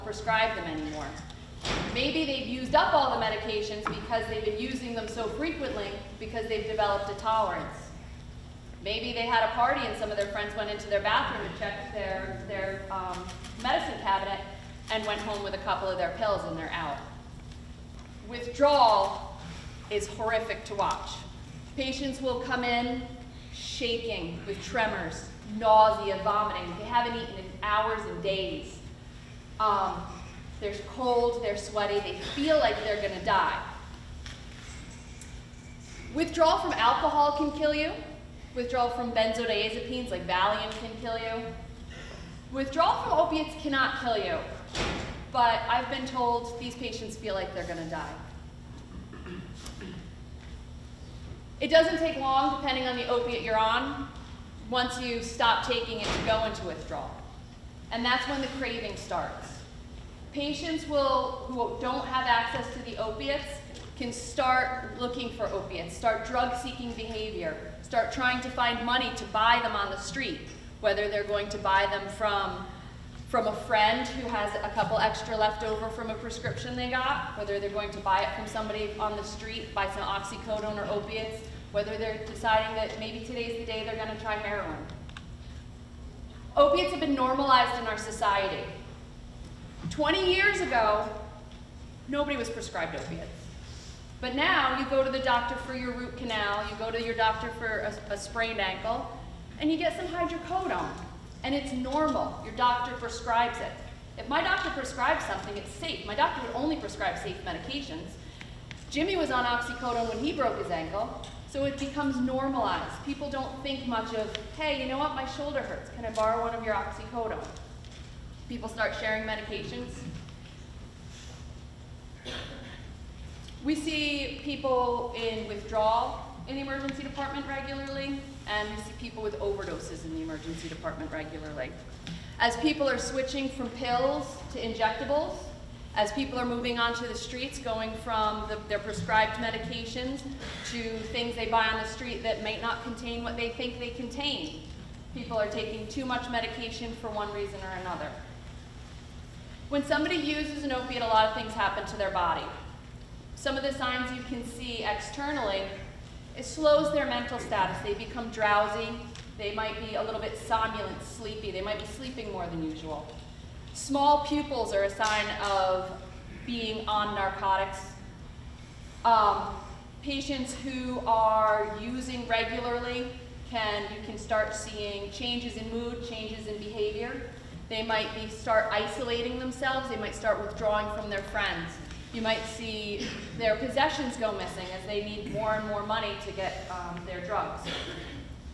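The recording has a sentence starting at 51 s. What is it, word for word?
It doesn't take long, depending on the opiate you're on, once you stop taking it to go into withdrawal.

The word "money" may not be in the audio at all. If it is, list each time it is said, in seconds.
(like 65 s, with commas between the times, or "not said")
68 s, 185 s.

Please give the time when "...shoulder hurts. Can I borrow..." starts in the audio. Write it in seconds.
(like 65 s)
115 s.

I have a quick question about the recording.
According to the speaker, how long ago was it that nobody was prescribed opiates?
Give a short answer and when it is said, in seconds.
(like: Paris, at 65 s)
20 years, at 89 s.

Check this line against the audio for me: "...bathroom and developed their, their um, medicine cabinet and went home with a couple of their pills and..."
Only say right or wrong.
wrong.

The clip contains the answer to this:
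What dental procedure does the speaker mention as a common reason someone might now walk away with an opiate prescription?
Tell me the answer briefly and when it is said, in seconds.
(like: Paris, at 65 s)
root canal, at 95 s.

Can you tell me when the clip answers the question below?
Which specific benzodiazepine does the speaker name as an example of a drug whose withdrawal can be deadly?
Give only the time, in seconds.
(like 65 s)
40 s.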